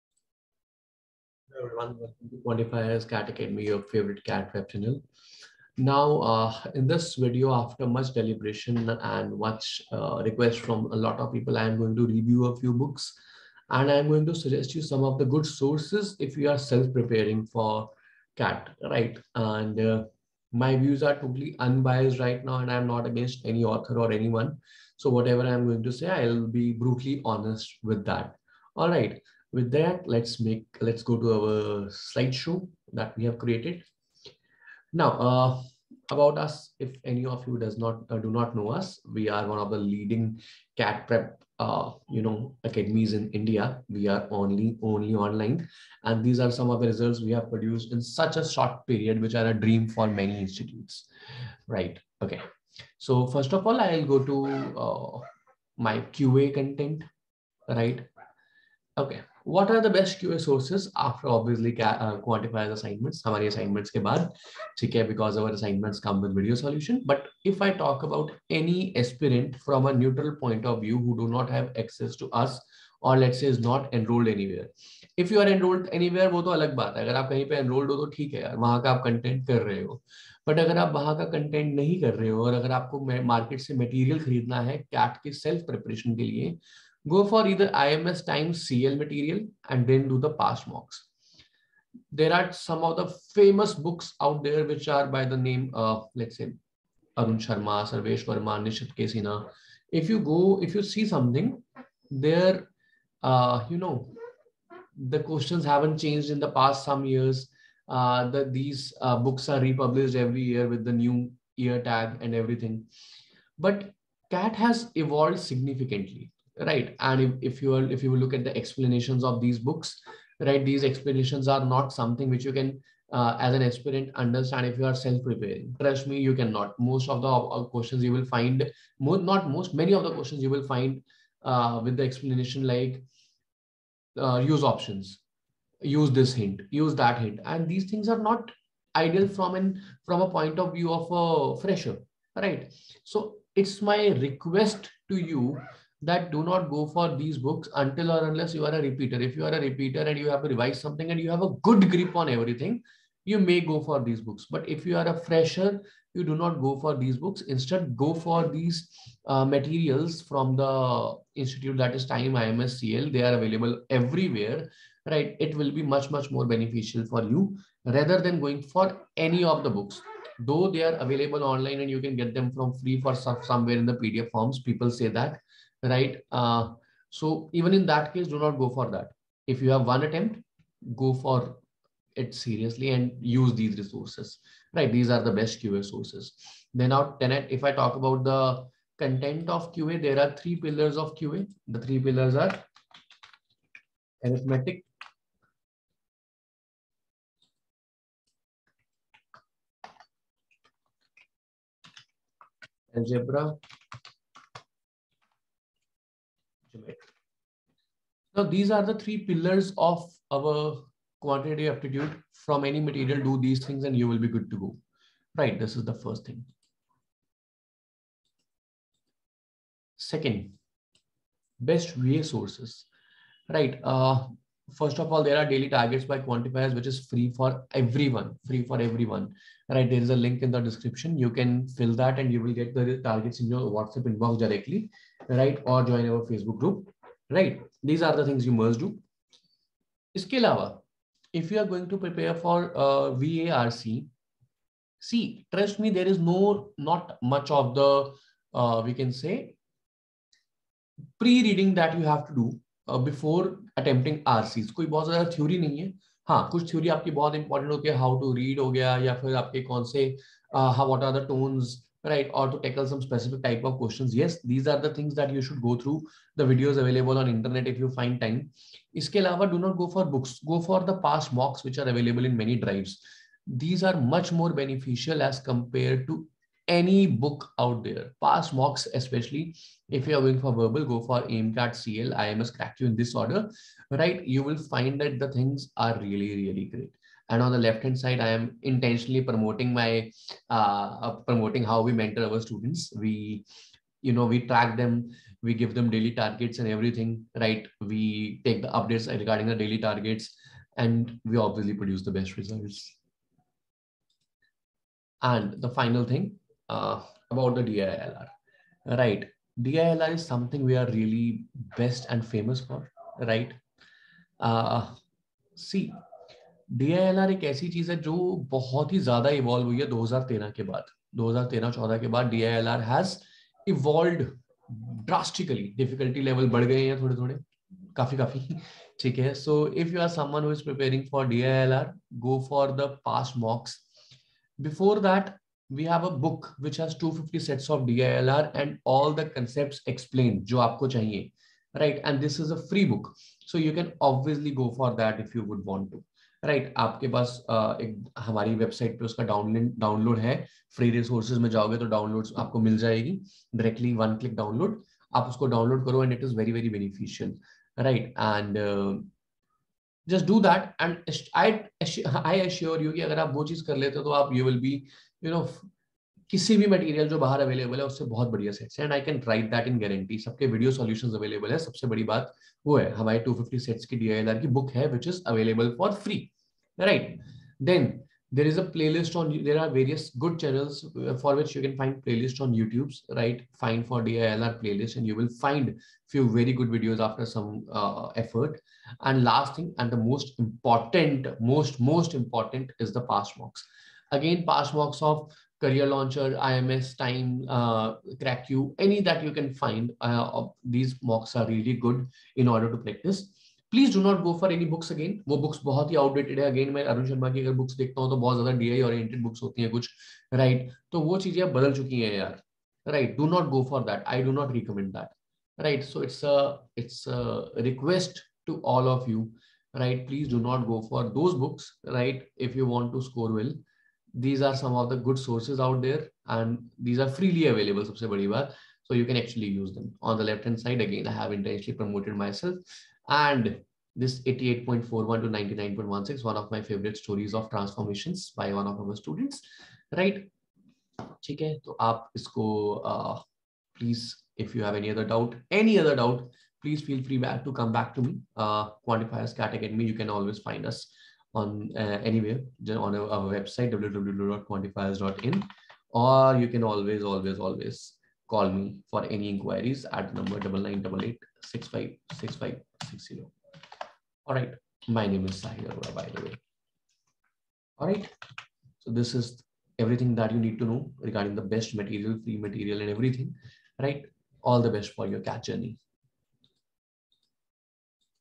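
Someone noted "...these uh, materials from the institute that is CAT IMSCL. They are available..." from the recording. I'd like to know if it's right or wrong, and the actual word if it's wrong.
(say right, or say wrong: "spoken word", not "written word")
wrong: "Time", not "CAT".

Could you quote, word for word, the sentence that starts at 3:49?
There is a link in the description.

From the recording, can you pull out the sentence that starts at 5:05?
And the final thing, uh, about the DILR.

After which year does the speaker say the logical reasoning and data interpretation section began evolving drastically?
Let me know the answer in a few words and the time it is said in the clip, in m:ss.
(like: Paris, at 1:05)
2013, at 5:19.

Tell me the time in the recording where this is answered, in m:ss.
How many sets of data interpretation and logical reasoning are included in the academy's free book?
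5:36.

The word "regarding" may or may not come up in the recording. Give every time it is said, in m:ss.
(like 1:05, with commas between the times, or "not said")
4:59, 7:50.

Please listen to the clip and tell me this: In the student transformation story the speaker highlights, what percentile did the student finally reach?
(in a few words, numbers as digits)
99.16.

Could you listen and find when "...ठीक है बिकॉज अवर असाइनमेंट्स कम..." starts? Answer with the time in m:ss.
1:04.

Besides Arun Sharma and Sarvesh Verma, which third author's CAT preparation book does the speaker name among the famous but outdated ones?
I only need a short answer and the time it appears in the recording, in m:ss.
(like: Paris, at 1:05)
Nishit K Sinha, at 1:38.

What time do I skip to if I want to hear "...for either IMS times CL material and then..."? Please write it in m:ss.
1:27.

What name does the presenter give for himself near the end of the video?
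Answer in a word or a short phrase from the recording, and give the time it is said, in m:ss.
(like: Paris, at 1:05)
Sahil Arora, at 7:45.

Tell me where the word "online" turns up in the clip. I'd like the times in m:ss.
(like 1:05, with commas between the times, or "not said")
0:45, 2:51.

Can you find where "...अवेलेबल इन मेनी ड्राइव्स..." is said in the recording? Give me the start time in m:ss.
4:31.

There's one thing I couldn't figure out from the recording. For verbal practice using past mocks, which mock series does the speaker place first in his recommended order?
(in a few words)
AIMCAT.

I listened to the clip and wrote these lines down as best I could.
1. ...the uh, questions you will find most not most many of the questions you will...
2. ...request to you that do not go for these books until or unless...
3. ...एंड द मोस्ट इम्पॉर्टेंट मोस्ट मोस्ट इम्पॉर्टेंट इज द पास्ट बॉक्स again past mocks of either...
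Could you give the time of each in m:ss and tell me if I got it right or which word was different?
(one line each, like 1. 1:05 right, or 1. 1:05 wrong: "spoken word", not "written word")
1. 2:07 right
2. 2:24 right
3. 6:29 wrong: "career", not "either".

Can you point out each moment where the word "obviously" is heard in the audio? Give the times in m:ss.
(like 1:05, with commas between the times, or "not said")
5:01, 5:44.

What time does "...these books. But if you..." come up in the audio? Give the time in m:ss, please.
2:34.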